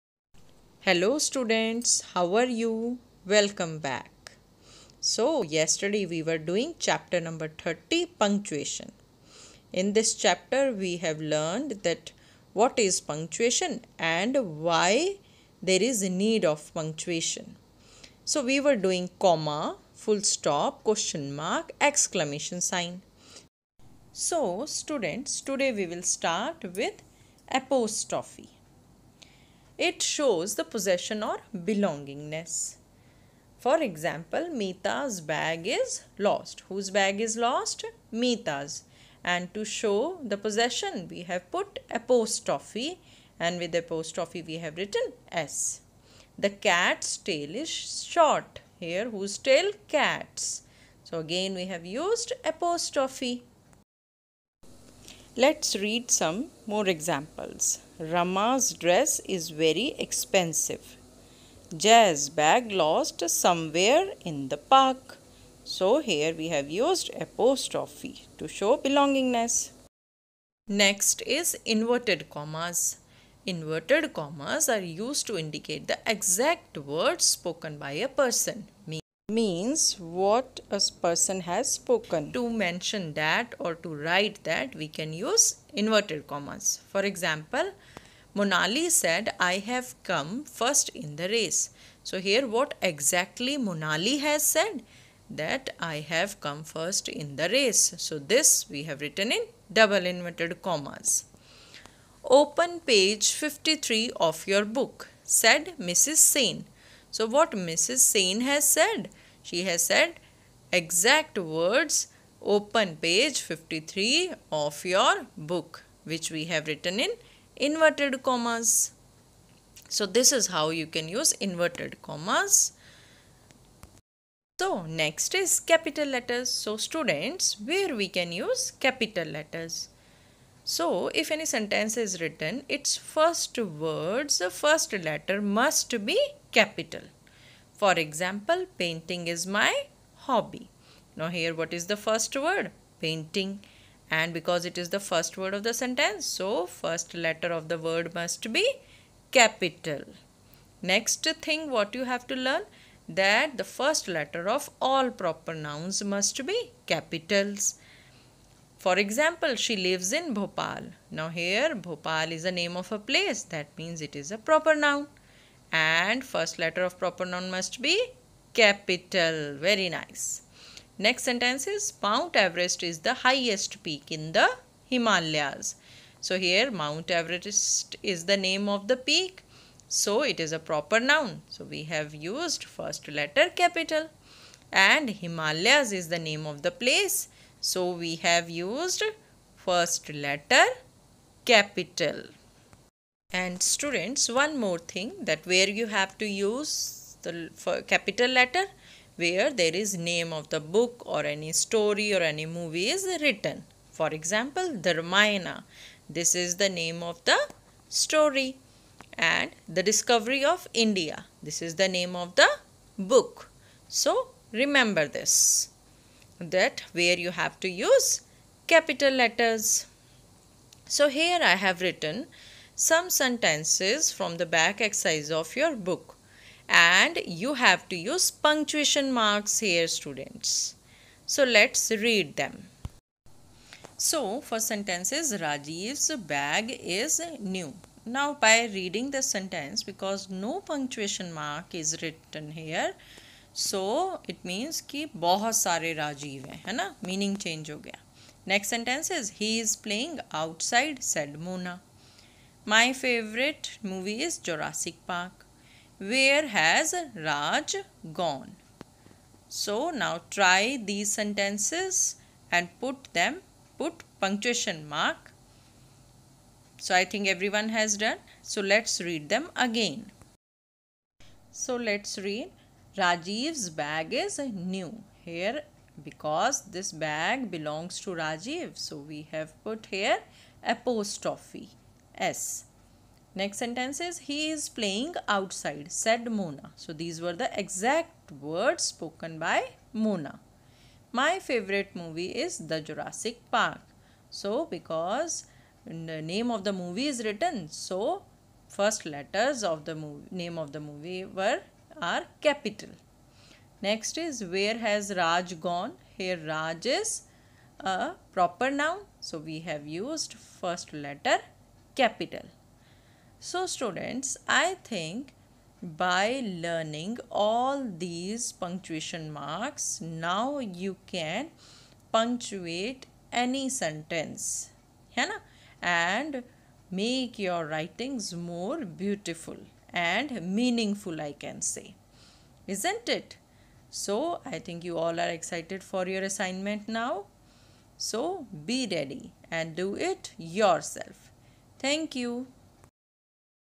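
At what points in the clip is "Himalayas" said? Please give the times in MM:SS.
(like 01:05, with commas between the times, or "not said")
02:54, 03:05.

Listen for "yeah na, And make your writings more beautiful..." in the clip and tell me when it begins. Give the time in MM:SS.
05:25.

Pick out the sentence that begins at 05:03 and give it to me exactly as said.
Next is where has Raj gone?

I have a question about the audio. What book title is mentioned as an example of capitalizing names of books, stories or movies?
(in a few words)
The Discovery of India.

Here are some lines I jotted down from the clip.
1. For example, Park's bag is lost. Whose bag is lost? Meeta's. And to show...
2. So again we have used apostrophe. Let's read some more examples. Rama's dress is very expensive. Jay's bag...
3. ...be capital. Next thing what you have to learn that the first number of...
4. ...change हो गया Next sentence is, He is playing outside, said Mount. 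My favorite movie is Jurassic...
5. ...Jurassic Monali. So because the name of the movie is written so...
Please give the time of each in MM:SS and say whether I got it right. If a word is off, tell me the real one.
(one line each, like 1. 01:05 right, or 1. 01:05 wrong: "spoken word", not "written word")
1. 00:33 wrong: "Meeta", not "Park"
2. 00:51 right
3. 02:28 wrong: "letter", not "number"
4. 04:07 wrong: "Mona", not "Mount"
5. 04:52 wrong: "Park", not "Monali".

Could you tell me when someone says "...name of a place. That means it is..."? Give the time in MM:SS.
02:42.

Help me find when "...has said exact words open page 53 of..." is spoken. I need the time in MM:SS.
01:49.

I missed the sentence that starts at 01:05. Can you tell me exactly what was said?
So here we have used apostrophe to show belongingness.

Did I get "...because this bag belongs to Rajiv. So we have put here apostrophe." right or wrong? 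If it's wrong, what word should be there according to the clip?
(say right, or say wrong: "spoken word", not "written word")
right.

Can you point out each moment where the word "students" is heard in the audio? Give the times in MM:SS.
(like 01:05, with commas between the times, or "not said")
00:01, 00:24, 02:06, 03:13, 03:49, 05:13.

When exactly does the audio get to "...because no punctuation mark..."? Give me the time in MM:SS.
03:59.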